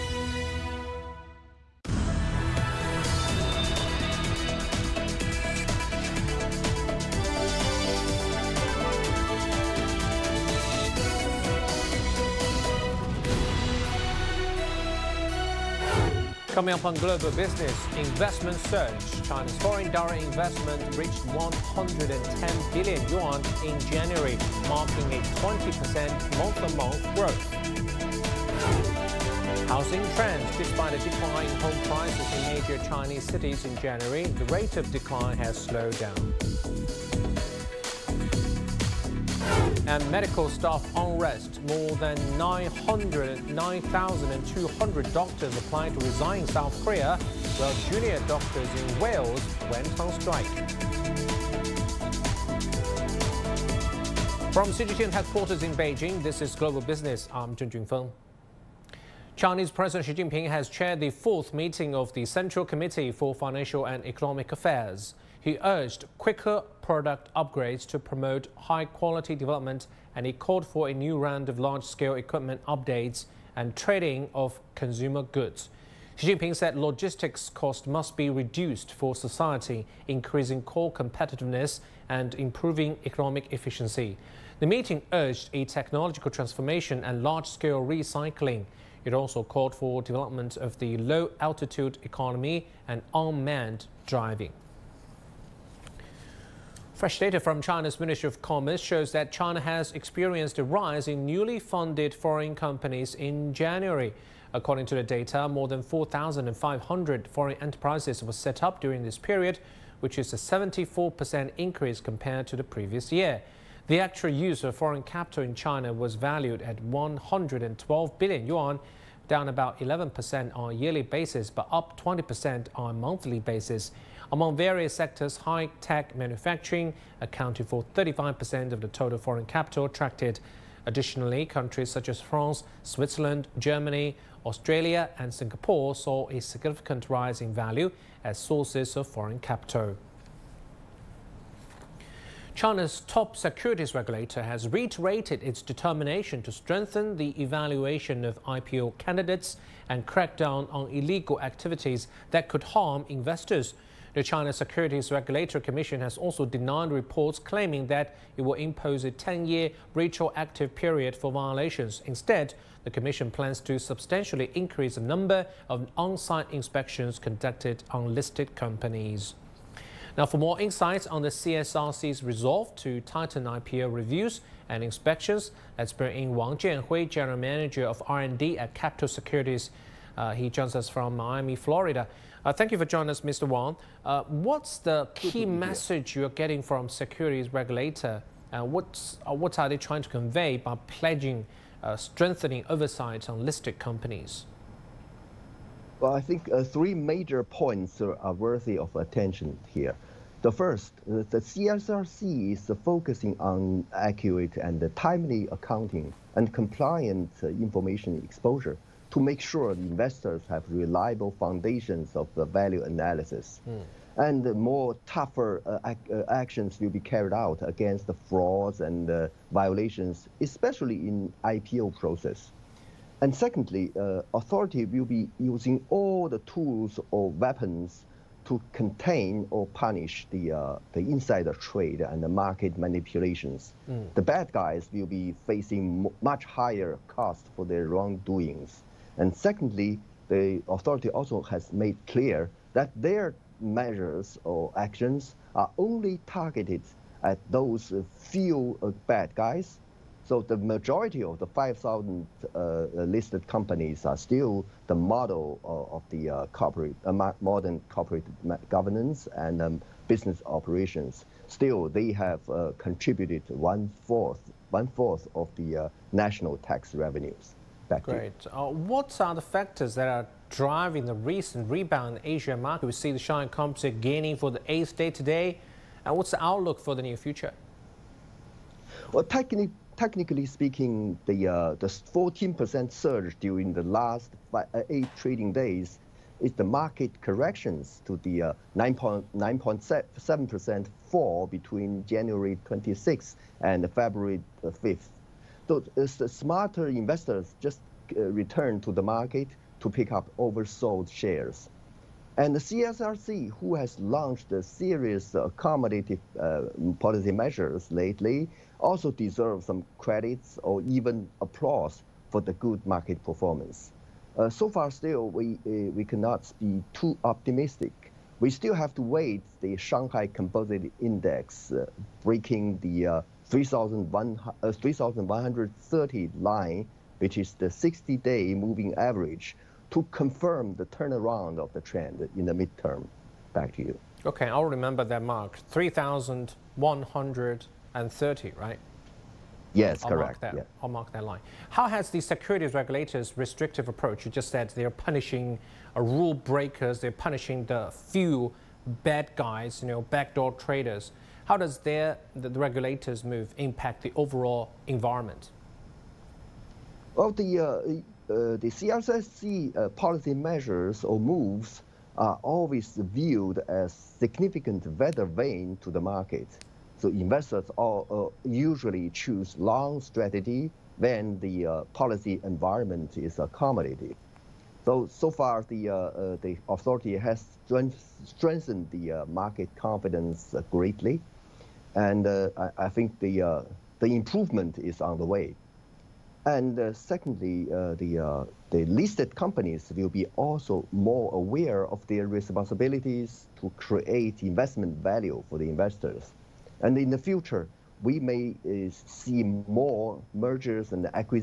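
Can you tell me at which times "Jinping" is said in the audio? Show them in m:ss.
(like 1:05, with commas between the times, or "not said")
1:00, 1:16.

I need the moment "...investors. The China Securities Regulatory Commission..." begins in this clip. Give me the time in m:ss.
2:33.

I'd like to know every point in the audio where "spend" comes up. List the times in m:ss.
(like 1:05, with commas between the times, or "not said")
not said.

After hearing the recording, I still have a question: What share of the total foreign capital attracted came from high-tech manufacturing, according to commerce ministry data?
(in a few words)
35%.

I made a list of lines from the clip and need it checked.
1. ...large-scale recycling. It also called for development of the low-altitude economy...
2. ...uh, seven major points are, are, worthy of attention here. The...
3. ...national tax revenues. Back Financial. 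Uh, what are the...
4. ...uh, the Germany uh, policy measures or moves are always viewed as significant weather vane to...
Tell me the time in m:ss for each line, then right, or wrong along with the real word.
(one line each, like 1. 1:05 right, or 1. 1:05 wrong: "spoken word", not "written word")
1. 1:27 right
2. 3:16 wrong: "three", not "seven"
3. 4:26 wrong: "Great", not "Financial"
4. 5:58 wrong: "CRSC", not "Germany".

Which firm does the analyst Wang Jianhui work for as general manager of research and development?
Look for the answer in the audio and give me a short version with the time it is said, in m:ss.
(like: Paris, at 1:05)
Capital Securities, at 2:58.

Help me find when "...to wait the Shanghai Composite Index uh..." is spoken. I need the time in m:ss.
5:18.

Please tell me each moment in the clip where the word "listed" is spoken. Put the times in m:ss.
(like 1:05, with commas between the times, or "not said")
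2:48, 3:13, 4:12, 6:28.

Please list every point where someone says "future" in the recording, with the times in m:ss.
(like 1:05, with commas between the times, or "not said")
4:37, 6:37.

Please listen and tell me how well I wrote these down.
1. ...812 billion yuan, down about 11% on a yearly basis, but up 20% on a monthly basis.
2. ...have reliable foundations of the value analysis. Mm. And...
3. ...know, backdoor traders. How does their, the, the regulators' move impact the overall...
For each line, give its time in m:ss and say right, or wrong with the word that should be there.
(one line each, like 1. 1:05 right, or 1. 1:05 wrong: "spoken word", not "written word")
1. 1:56 wrong: "112", not "812"
2. 3:30 right
3. 5:49 right.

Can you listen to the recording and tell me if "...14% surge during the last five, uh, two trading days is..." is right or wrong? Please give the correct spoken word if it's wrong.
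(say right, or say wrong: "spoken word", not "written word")
wrong: "eight", not "two".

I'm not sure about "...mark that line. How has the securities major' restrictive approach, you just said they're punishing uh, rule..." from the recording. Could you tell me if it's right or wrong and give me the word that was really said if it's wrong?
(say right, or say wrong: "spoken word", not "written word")
wrong: "regulators", not "major".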